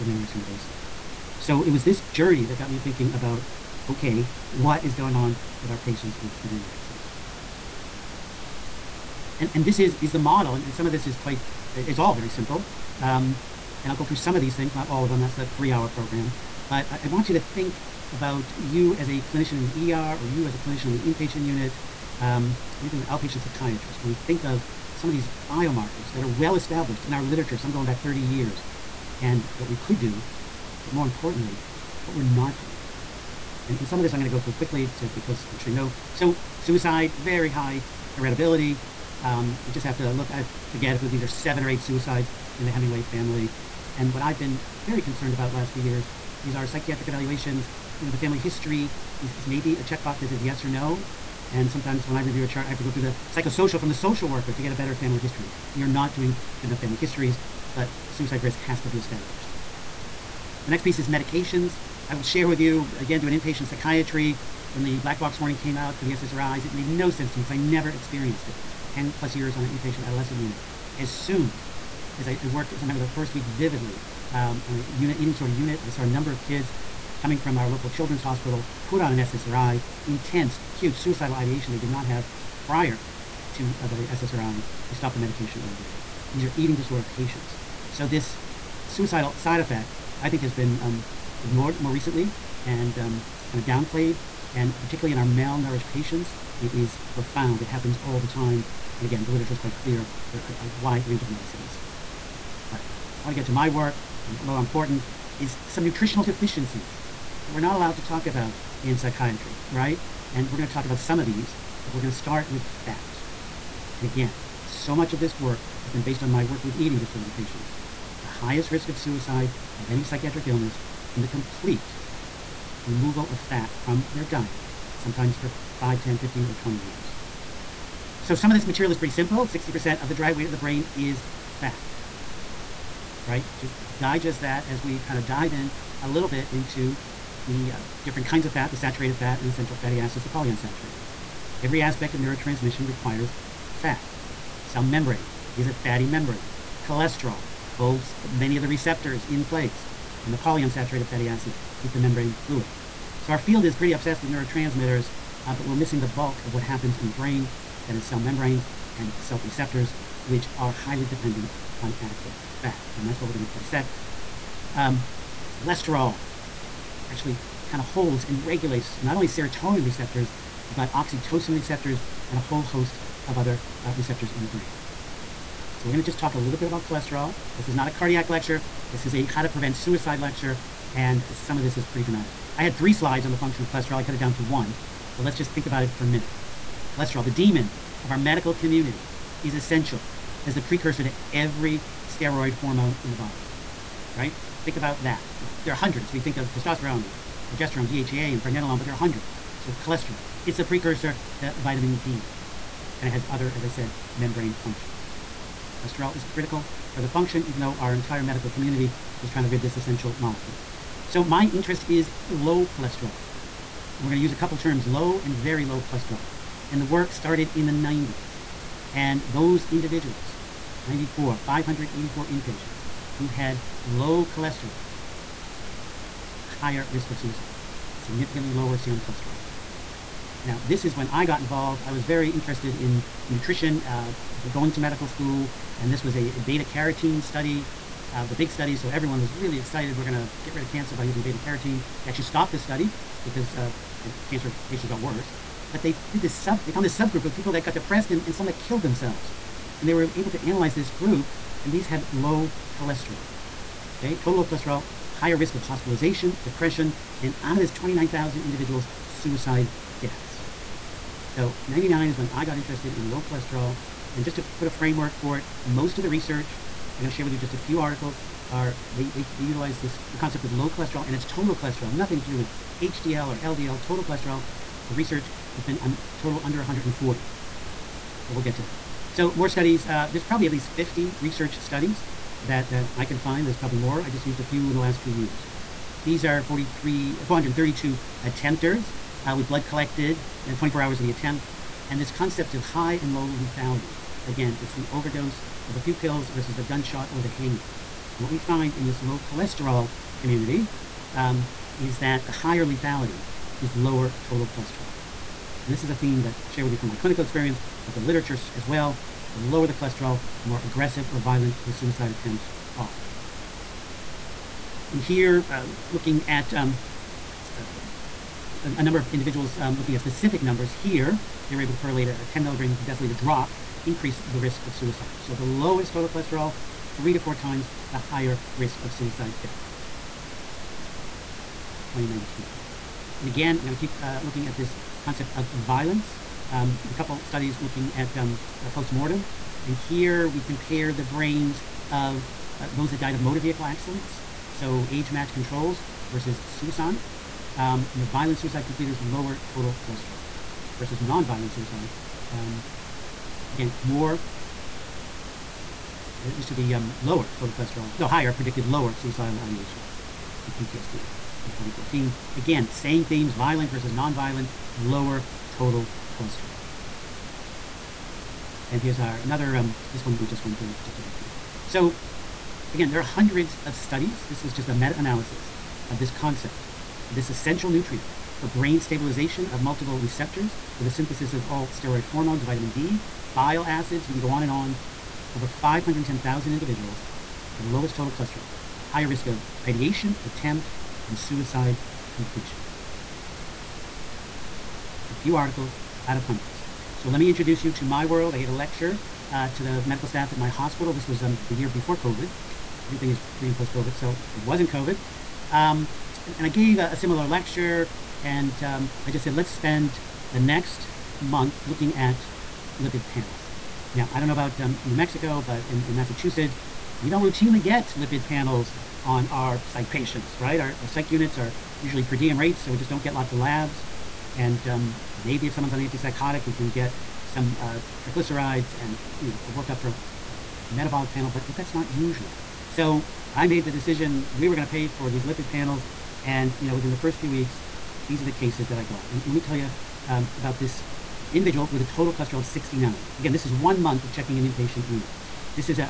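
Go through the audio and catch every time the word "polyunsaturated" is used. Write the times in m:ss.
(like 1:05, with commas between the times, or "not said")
2:20, 2:30.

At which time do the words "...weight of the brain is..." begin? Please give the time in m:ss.
2:10.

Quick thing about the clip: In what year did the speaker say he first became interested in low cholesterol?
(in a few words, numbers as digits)
1999.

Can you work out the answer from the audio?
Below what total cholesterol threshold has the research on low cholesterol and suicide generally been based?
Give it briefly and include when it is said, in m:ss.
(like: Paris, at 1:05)
140, at 4:36.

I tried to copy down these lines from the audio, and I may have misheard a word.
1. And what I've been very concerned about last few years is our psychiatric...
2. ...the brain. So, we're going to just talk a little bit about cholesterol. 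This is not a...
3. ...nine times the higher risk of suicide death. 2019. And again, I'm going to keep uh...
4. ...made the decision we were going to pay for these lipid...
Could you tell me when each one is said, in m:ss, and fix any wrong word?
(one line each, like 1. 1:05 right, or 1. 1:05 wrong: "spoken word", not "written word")
1. 0:43 right
2. 2:54 right
3. 5:27 wrong: "four", not "nine"
4. 7:13 right.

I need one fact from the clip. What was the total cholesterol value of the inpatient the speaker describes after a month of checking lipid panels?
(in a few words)
69.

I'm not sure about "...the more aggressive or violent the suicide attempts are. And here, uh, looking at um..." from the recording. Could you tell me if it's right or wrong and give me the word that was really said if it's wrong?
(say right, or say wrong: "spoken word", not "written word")
right.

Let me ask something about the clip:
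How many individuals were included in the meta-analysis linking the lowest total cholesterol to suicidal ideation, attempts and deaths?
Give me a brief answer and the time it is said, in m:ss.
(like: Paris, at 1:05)
510,000, at 6:25.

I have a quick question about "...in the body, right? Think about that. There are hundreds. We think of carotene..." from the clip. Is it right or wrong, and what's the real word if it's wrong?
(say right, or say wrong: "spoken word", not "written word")
wrong: "testosterone", not "carotene".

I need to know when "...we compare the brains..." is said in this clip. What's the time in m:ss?
5:40.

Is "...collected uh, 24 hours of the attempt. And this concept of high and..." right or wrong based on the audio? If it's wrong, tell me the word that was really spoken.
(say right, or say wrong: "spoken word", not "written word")
right.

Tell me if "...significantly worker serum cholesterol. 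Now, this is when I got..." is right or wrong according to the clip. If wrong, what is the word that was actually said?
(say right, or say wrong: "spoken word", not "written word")
wrong: "lower", not "worker".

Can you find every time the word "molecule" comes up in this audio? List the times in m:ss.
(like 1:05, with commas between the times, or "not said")
3:30.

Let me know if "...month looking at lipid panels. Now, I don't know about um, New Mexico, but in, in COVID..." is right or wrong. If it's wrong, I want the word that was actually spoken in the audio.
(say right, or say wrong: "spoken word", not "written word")
wrong: "Massachusetts", not "COVID".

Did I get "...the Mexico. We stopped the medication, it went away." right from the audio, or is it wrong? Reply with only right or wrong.
wrong.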